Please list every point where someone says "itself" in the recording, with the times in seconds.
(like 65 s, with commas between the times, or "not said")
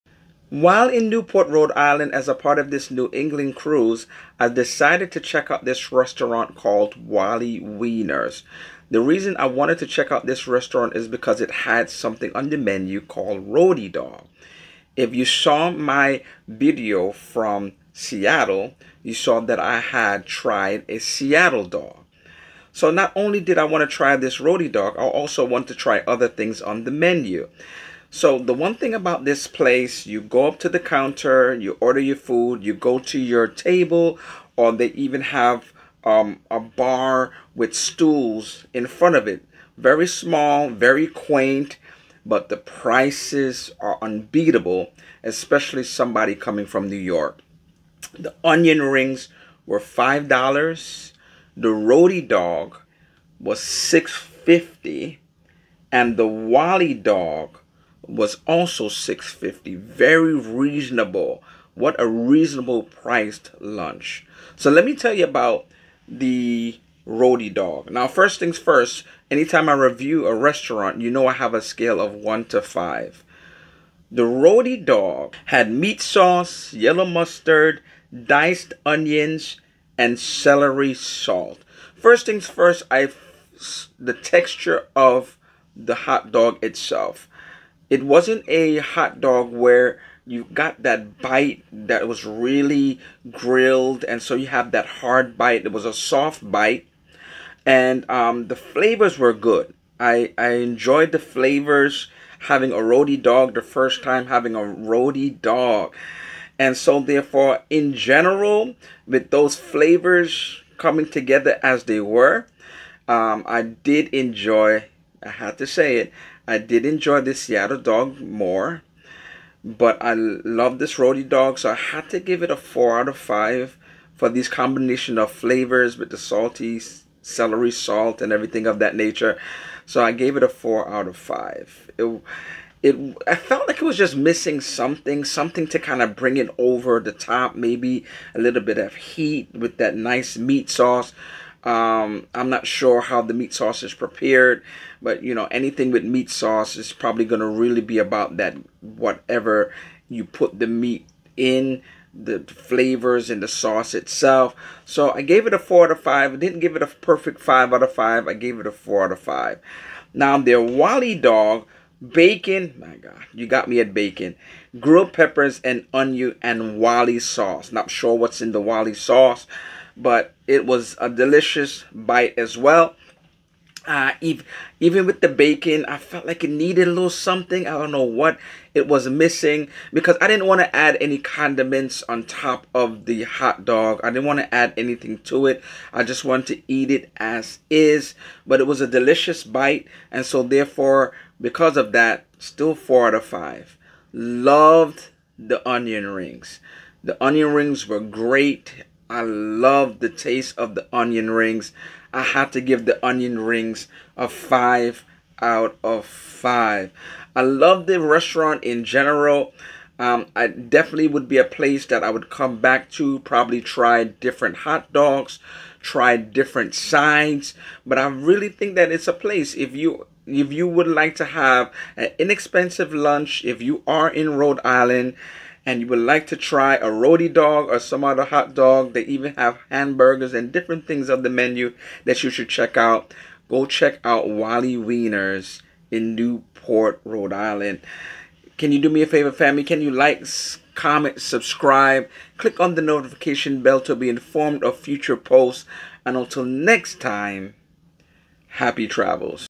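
86 s, 153 s.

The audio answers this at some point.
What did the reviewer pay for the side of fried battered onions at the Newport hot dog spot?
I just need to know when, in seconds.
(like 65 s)
48 s.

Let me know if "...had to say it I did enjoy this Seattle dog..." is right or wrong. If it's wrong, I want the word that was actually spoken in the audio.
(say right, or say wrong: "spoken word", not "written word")
right.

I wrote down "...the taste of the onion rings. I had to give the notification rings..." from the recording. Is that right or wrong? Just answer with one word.
wrong.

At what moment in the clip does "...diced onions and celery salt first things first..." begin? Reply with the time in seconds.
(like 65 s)
78 s.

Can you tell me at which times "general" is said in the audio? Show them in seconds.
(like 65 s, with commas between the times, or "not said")
107 s, 208 s.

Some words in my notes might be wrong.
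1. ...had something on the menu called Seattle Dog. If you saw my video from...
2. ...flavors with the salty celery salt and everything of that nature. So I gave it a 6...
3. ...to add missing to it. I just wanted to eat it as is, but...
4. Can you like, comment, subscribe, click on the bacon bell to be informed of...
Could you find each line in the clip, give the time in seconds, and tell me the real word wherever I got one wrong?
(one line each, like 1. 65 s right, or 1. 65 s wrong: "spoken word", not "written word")
1. 11 s wrong: "Rhody", not "Seattle"
2. 125 s wrong: "4", not "6"
3. 184 s wrong: "anything", not "missing"
4. 239 s wrong: "notification", not "bacon".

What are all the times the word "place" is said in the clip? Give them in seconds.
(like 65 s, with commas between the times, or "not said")
29 s, 211 s, 219 s.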